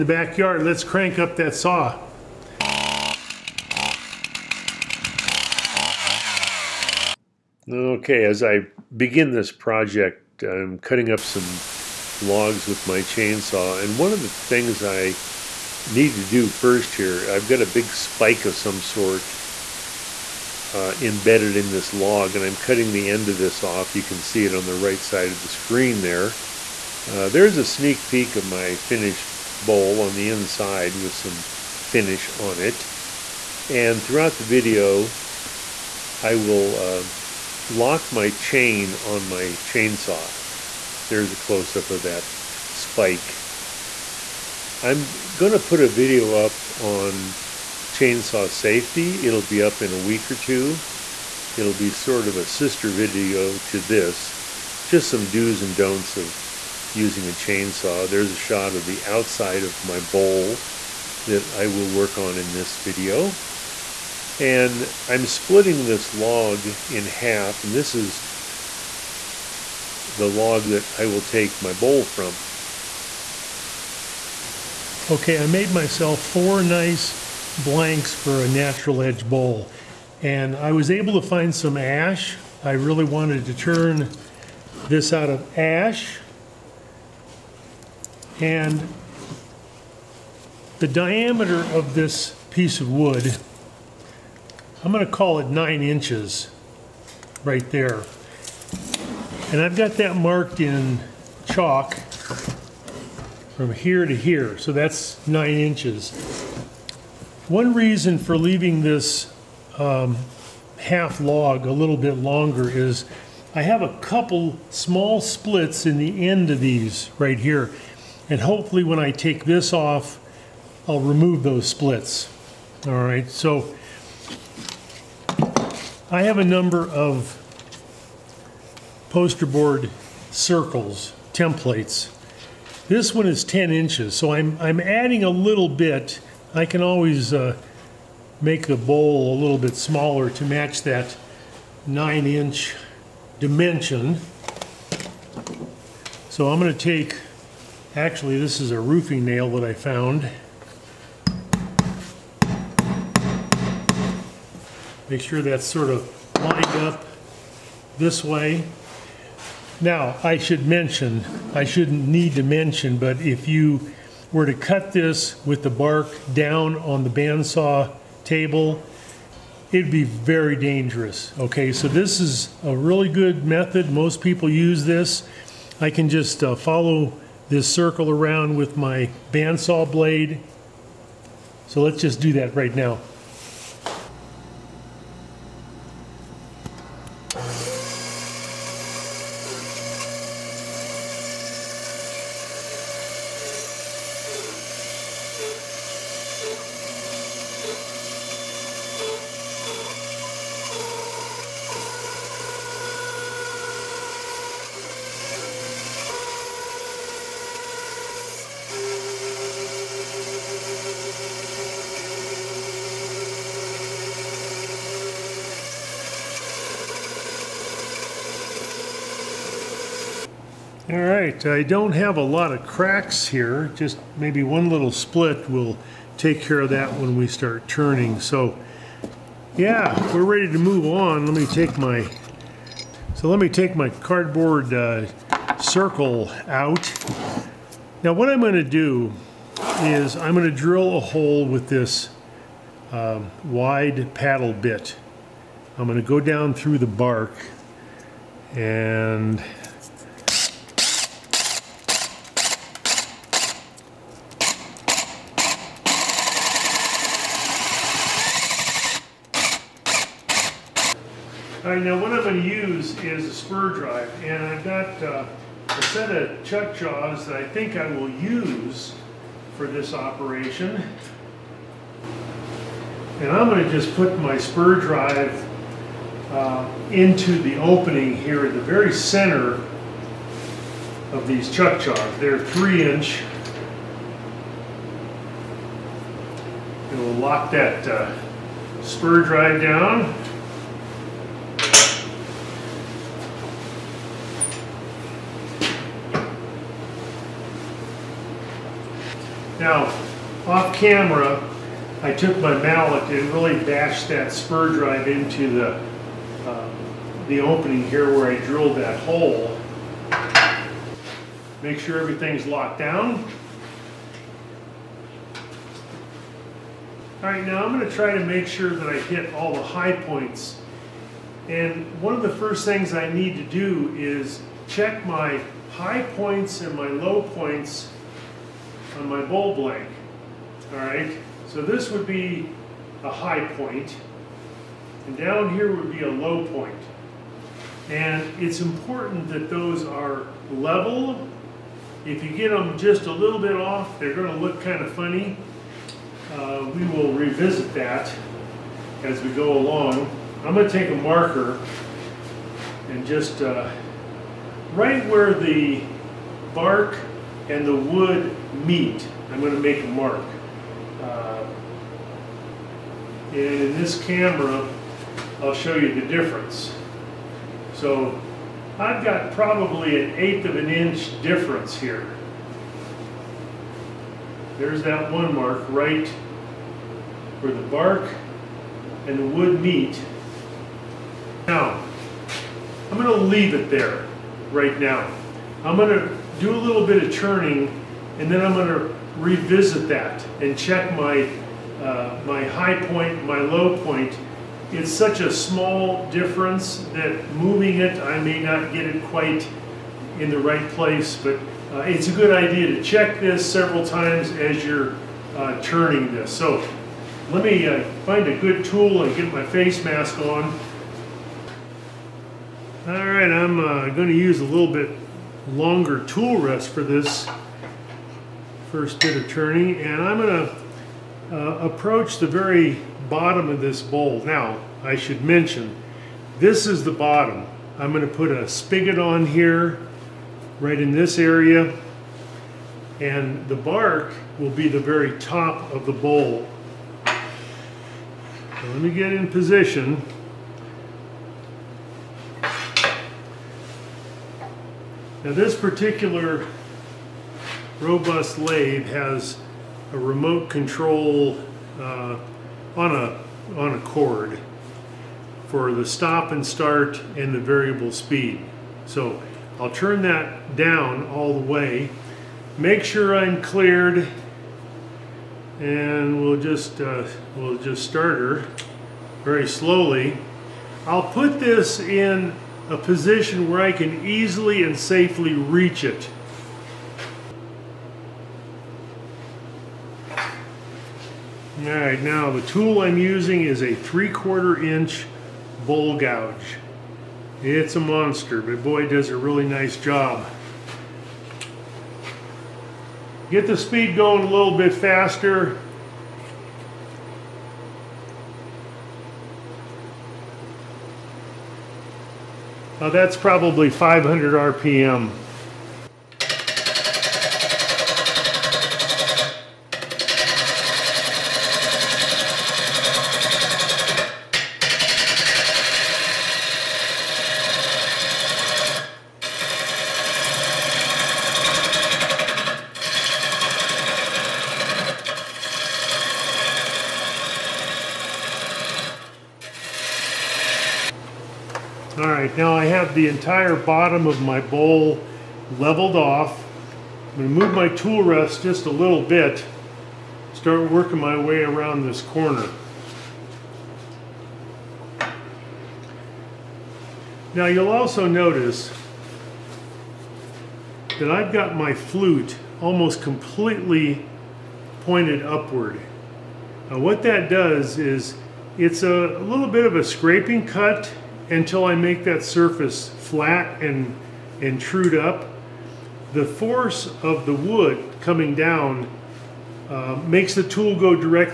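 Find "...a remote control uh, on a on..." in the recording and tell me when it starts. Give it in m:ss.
7:29.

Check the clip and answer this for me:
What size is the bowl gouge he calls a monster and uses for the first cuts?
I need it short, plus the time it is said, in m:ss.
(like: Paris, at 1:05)
3/4 inch, at 8:03.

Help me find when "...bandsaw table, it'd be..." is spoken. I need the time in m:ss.
2:47.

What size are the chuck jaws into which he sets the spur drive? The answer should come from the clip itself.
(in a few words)
3 inch.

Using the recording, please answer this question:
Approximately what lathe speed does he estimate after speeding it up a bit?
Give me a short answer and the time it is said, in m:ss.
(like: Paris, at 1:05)
500 RPM, at 8:23.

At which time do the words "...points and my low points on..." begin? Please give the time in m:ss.
5:26.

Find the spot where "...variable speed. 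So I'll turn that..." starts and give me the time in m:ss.
7:37.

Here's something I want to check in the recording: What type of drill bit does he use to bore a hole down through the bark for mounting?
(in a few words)
paddle bit.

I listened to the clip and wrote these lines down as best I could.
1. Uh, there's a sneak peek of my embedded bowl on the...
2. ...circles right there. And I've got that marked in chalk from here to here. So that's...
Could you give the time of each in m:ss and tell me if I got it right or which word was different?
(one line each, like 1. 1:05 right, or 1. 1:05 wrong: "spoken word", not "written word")
1. 0:27 wrong: "finished", not "embedded"
2. 1:35 wrong: "inches", not "circles".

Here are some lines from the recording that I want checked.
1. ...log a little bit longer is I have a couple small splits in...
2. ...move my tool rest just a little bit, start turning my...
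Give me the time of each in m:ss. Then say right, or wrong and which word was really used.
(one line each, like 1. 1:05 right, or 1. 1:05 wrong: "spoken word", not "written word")
1. 1:51 right
2. 8:57 wrong: "working", not "turning".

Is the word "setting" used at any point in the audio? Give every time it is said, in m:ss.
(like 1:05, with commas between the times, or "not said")
not said.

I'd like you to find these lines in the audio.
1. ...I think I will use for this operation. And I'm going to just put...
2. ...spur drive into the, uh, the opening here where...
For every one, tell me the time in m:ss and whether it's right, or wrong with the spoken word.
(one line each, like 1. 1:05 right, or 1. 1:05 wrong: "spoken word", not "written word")
1. 4:27 right
2. 5:04 right.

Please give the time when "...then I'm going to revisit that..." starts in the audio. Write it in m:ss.
6:28.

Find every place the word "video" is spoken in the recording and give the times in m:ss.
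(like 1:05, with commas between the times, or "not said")
0:34, 0:45, 0:52, 1:02.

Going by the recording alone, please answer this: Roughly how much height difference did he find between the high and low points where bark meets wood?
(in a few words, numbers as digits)
an eighth of an inch.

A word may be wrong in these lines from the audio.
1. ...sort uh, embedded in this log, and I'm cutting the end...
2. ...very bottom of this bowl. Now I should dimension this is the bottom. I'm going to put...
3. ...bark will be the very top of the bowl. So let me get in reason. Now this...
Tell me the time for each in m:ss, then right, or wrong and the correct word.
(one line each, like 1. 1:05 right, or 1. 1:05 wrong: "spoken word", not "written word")
1. 0:18 right
2. 7:02 wrong: "mention", not "dimension"
3. 7:13 wrong: "position", not "reason".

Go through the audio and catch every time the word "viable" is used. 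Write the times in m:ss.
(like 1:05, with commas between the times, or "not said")
not said.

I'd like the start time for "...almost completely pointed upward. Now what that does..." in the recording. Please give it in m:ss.
9:12.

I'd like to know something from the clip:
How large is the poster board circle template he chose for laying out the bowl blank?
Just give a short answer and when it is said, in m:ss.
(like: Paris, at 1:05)
10 inches, at 2:13.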